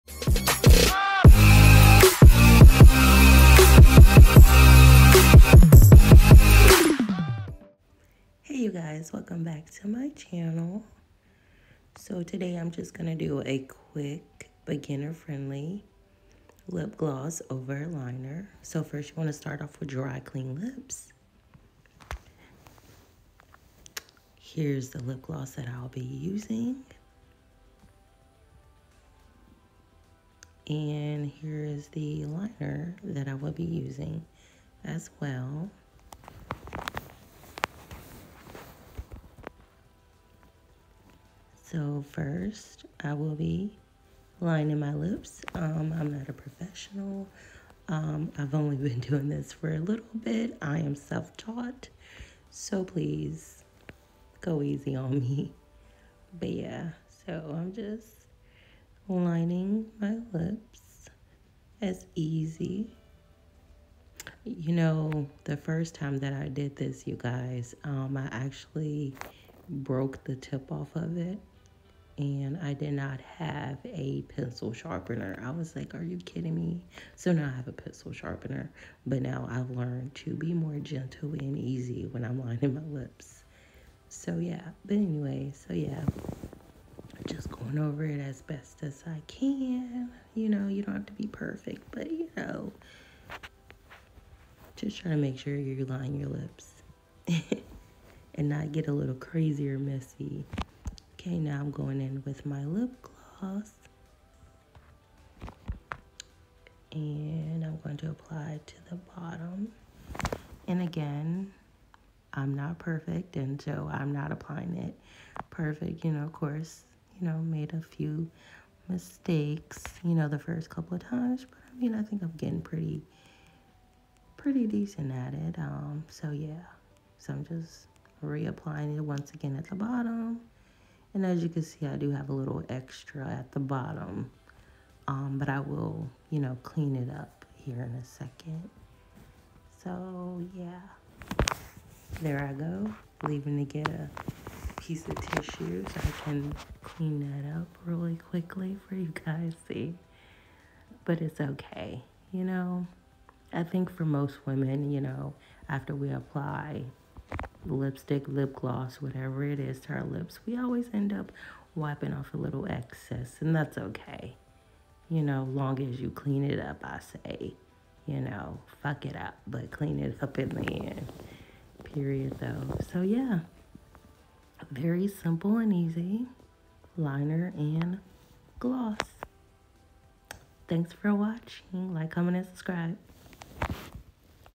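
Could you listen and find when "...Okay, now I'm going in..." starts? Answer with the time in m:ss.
1:41.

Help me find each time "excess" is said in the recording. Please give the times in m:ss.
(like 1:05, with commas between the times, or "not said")
2:42.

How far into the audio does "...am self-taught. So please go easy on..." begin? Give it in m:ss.
0:50.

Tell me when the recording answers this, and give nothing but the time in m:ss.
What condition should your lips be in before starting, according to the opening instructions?
0:19.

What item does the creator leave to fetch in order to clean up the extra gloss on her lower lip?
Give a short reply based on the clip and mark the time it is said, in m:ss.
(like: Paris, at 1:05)
tissue, at 2:25.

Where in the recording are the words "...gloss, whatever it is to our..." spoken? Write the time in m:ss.
2:38.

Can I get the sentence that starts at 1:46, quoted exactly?
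And I'm going to apply to the bottom.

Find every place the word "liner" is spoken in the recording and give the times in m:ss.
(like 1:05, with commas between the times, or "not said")
0:17, 0:32, 2:56.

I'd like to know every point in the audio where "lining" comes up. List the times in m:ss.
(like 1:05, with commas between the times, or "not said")
0:44, 0:59, 1:22, 1:35.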